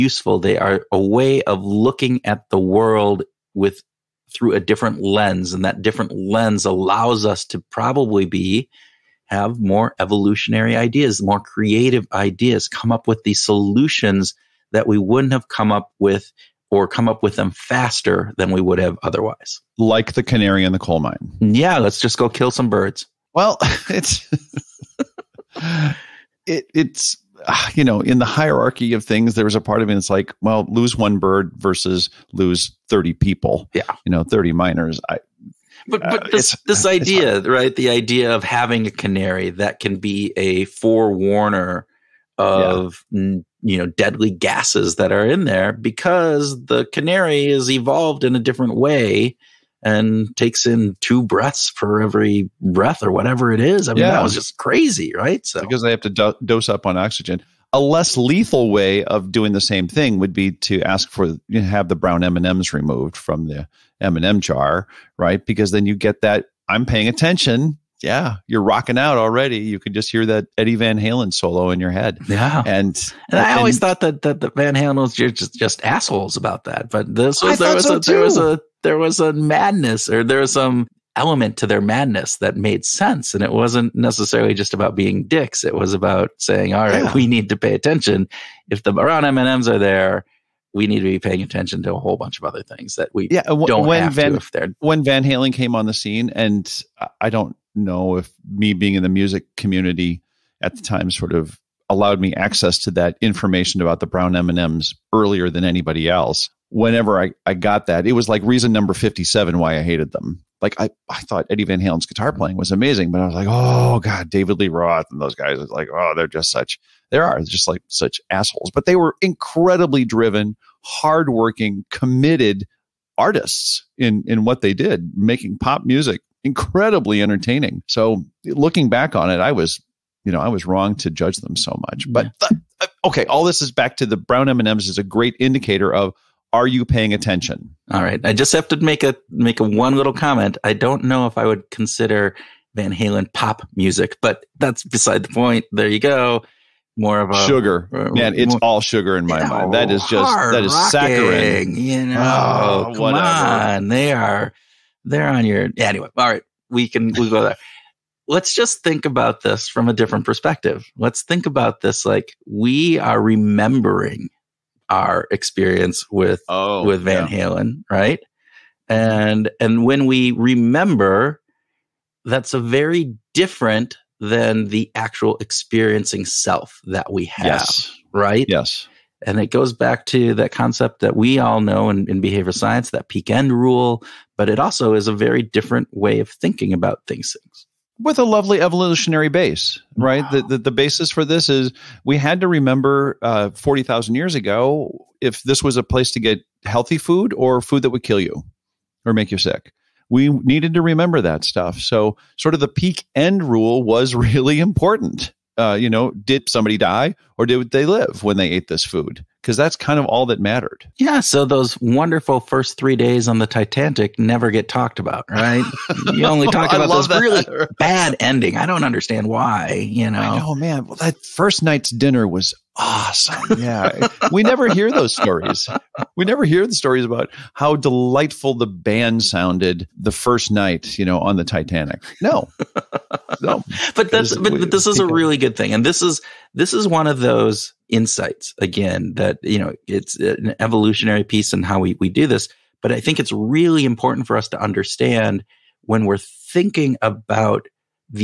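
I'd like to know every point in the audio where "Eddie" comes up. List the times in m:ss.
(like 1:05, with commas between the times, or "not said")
1:10, 1:51.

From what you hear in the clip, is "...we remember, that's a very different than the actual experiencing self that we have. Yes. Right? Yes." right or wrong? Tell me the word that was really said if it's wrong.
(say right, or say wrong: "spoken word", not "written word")
right.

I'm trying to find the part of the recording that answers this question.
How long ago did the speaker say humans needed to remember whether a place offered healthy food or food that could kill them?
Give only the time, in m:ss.
3:13.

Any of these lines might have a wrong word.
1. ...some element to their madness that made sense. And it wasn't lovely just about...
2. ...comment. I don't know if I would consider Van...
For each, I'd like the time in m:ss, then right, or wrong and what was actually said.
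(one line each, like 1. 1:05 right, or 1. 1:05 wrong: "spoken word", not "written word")
1. 1:20 wrong: "necessarily", not "lovely"
2. 2:20 right.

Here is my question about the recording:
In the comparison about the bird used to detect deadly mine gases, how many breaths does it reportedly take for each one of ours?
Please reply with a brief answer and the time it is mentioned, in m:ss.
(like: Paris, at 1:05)
2, at 0:51.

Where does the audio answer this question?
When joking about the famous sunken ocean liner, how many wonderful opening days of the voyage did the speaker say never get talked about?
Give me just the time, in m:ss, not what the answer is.
3:32.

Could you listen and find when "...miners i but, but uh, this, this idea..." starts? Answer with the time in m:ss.
0:34.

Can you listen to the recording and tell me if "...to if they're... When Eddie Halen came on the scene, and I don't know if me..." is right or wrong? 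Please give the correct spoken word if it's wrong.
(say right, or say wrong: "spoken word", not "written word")
wrong: "Van", not "Eddie".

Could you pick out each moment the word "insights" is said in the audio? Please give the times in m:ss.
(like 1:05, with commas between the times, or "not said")
3:57.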